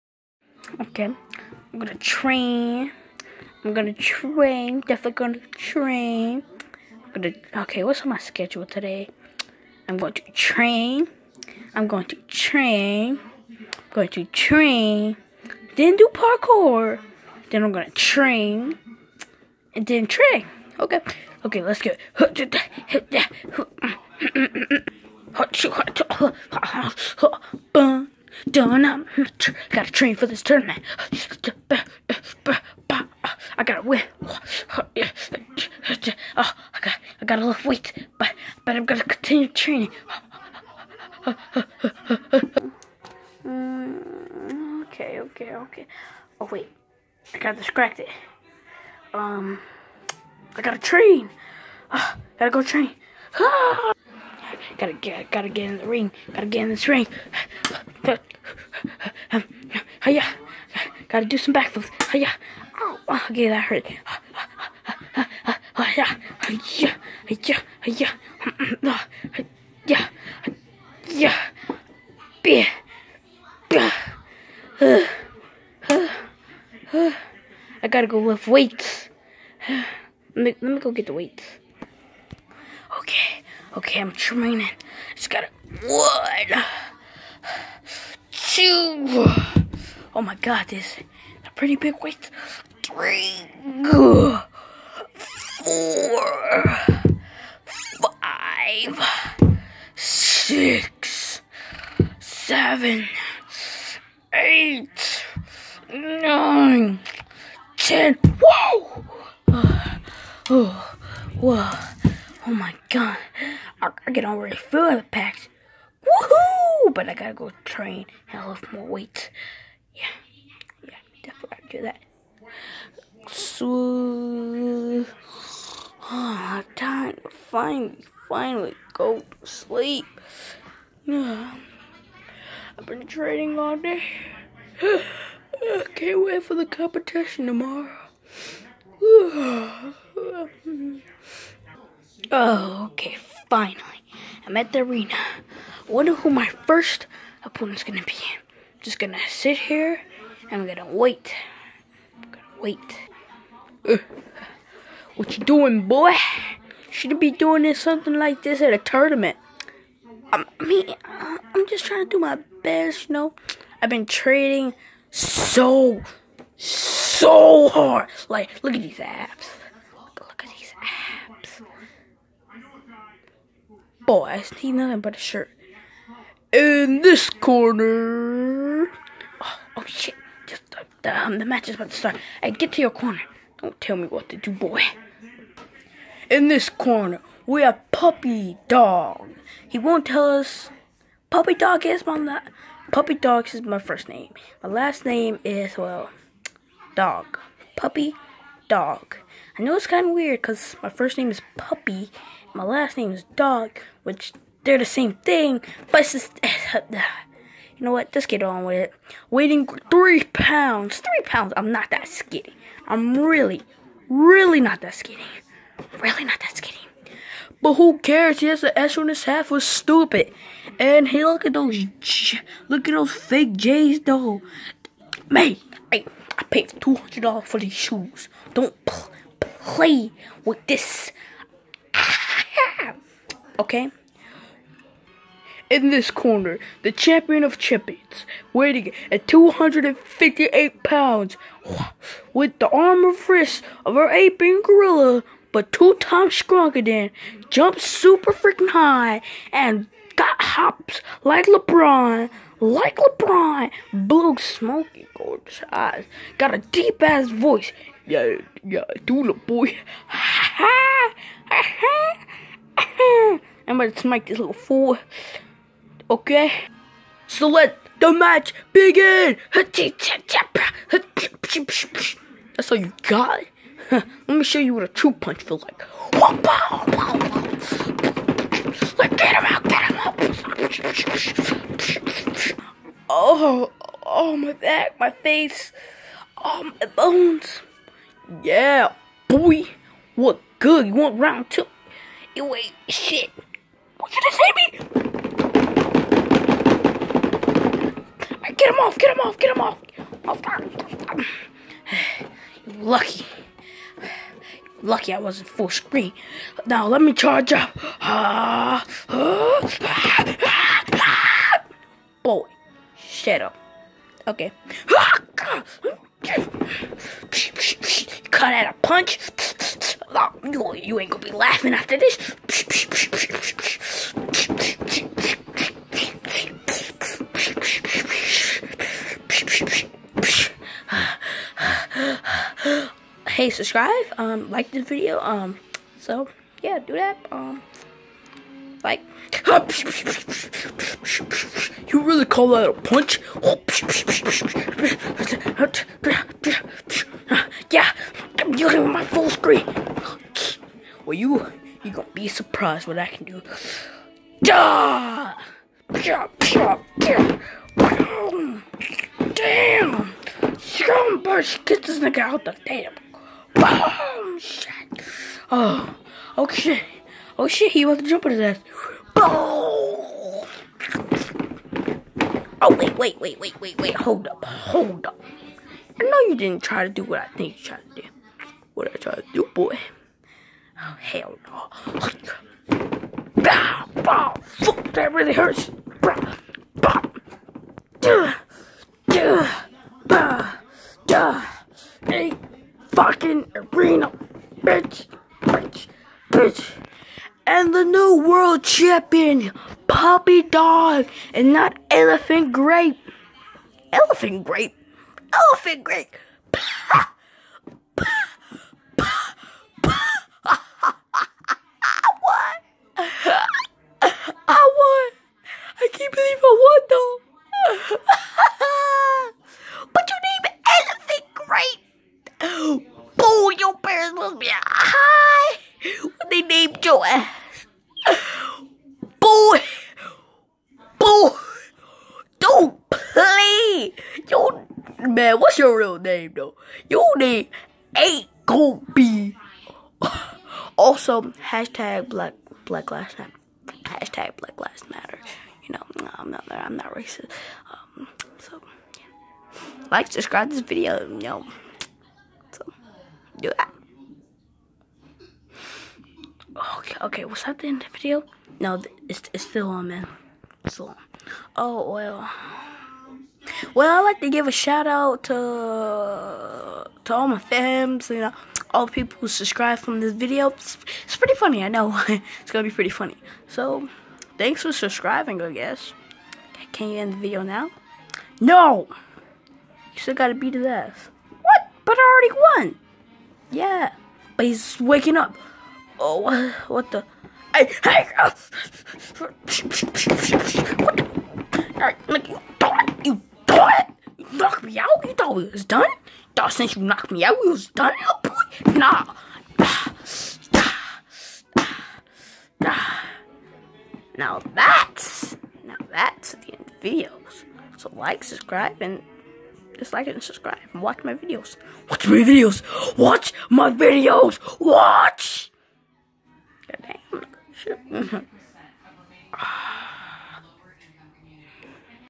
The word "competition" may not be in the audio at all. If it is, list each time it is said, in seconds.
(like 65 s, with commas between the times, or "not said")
136 s.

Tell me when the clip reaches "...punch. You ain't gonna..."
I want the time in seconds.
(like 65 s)
318 s.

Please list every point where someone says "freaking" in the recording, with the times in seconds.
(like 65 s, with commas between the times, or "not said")
248 s.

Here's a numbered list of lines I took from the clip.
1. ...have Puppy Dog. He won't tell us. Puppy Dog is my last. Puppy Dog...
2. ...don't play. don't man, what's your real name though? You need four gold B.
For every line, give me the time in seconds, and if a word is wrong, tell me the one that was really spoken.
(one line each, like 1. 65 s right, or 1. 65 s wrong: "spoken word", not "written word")
1. 187 s right
2. 432 s wrong: "eight", not "four".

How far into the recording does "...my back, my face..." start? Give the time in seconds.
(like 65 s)
284 s.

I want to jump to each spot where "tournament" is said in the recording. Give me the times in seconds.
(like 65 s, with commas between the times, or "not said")
30 s, 158 s.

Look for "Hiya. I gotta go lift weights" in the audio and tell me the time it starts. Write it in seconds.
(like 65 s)
74 s.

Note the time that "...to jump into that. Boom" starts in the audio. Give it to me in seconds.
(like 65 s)
367 s.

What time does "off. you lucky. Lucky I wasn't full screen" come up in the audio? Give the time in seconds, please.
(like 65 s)
300 s.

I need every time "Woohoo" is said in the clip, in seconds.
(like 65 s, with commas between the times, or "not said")
116 s.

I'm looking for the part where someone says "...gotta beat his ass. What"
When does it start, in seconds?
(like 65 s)
480 s.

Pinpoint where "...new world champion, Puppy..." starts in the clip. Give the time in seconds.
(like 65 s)
397 s.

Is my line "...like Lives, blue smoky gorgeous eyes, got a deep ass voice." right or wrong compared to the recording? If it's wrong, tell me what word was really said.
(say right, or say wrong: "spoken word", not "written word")
wrong: "LeBron", not "Lives".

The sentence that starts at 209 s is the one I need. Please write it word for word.
Weighing three pounds, three pounds, I'm not that skinny.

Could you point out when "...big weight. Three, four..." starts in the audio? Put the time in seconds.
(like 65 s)
91 s.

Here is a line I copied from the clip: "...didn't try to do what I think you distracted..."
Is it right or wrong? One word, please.
wrong.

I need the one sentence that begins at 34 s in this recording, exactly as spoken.
Oh, I got I gotta lift weight, but but I'm gonna continue training.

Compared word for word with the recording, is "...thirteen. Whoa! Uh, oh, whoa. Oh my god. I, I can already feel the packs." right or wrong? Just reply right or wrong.
wrong.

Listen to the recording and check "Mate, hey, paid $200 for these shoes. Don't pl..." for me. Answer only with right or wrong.
right.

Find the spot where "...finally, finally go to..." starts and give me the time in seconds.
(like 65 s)
127 s.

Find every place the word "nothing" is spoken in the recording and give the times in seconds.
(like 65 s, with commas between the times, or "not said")
174 s.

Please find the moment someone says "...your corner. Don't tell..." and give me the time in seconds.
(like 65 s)
182 s.